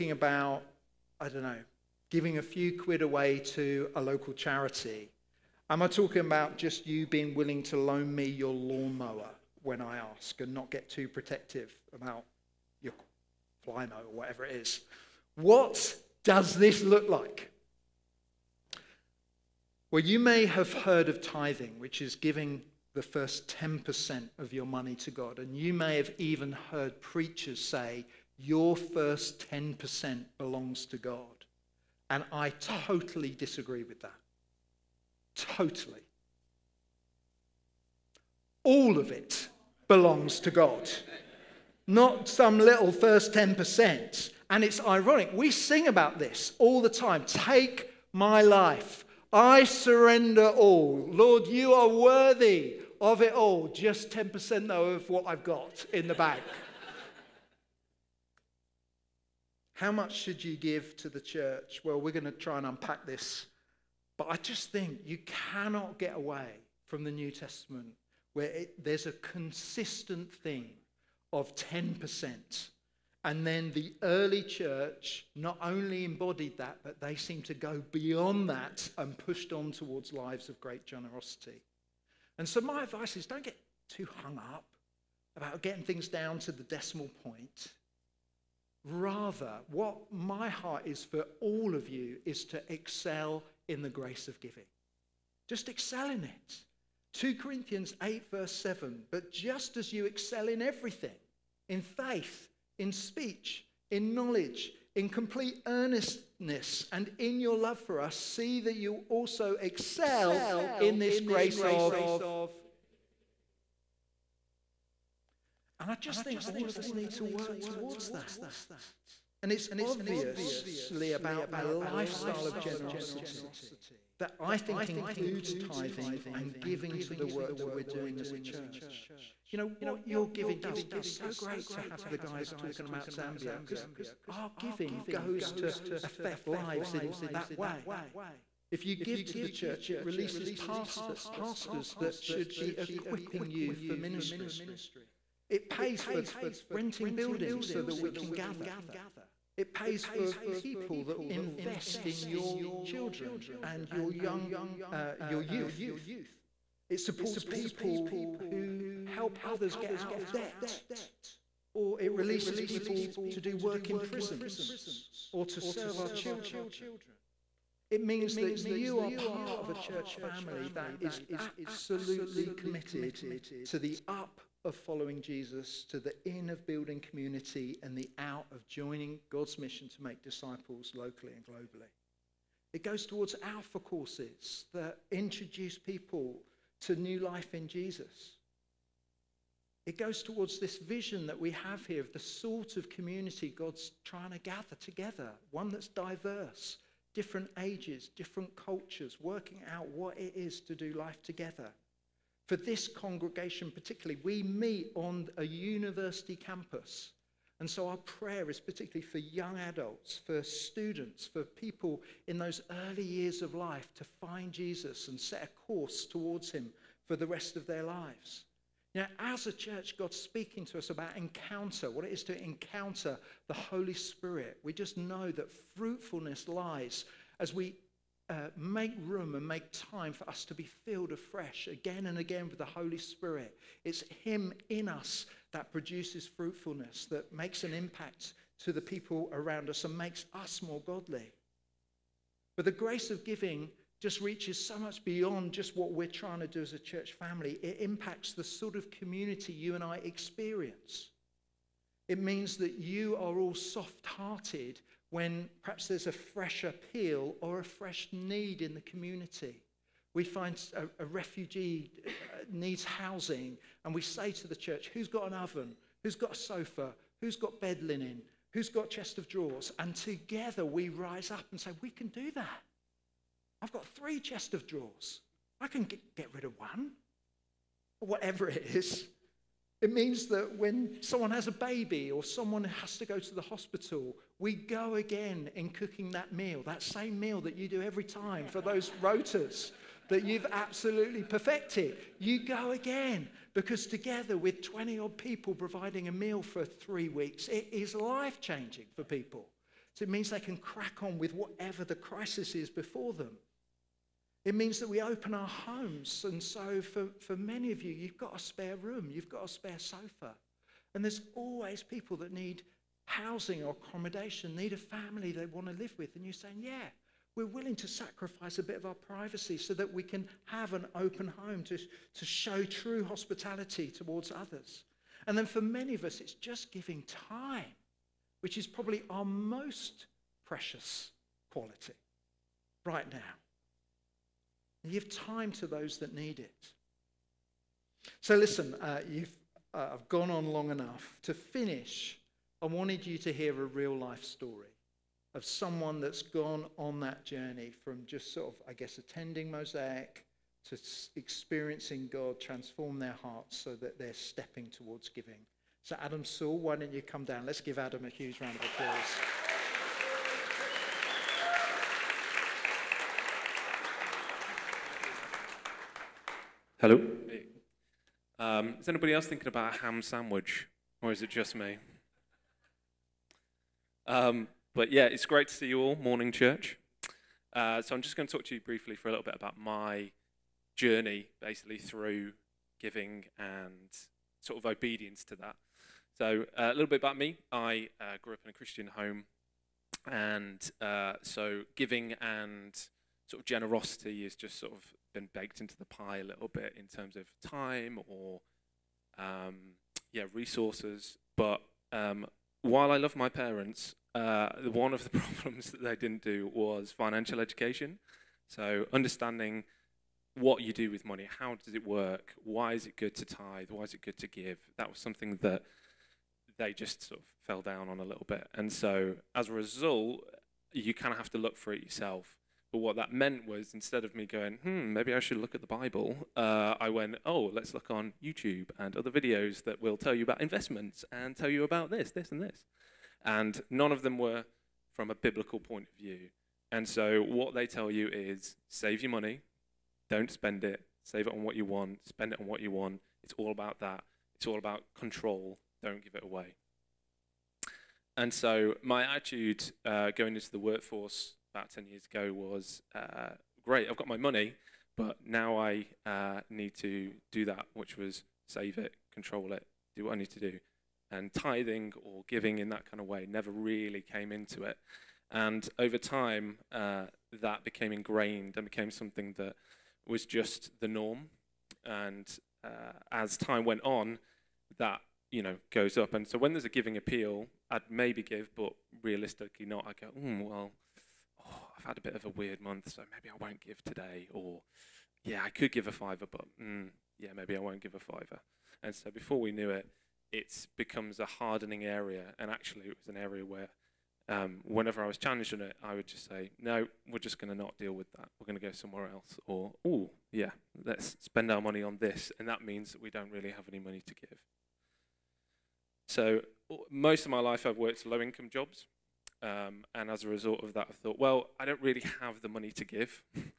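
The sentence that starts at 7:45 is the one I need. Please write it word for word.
And over time, uh, that became ingrained and became something that was just the norm.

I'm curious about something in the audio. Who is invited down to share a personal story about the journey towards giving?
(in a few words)
Adam Saul.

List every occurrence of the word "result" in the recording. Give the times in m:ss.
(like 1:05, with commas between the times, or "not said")
6:59, 8:30.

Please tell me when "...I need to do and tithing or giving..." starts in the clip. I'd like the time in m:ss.
7:40.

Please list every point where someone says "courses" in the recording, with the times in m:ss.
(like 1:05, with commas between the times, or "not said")
3:03, 3:35.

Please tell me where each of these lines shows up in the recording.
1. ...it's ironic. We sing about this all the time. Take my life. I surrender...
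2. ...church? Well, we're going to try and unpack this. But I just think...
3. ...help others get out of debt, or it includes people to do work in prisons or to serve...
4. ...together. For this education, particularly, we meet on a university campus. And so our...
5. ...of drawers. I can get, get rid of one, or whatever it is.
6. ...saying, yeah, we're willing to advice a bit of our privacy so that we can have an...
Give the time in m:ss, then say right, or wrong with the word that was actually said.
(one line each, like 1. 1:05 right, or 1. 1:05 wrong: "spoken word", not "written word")
1. 0:44 right
2. 1:01 right
3. 2:39 wrong: "releases", not "includes"
4. 3:21 wrong: "congregation", not "education"
5. 4:34 right
6. 5:16 wrong: "sacrifice", not "advice".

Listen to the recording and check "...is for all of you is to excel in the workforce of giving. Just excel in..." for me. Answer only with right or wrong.
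wrong.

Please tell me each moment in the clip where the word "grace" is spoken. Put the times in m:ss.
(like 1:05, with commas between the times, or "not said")
1:33, 1:51, 4:02.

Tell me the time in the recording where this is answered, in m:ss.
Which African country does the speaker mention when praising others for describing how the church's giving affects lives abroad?
2:13.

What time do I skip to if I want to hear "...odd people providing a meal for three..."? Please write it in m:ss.
4:54.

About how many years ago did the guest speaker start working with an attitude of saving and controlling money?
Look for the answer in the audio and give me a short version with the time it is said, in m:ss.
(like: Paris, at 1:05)
10 years, at 7:31.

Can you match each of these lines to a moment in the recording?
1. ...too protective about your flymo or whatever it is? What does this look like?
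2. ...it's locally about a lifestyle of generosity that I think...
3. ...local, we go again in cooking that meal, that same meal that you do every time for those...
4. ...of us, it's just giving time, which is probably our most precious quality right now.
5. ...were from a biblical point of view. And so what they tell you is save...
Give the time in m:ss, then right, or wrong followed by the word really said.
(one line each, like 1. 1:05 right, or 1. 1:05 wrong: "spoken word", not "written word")
1. 0:10 right
2. 1:59 wrong: "obviously", not "locally"
3. 4:43 wrong: "hospital", not "local"
4. 5:25 right
5. 7:14 right.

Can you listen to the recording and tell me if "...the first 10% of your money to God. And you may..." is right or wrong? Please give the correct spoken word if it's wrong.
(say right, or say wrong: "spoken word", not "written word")
right.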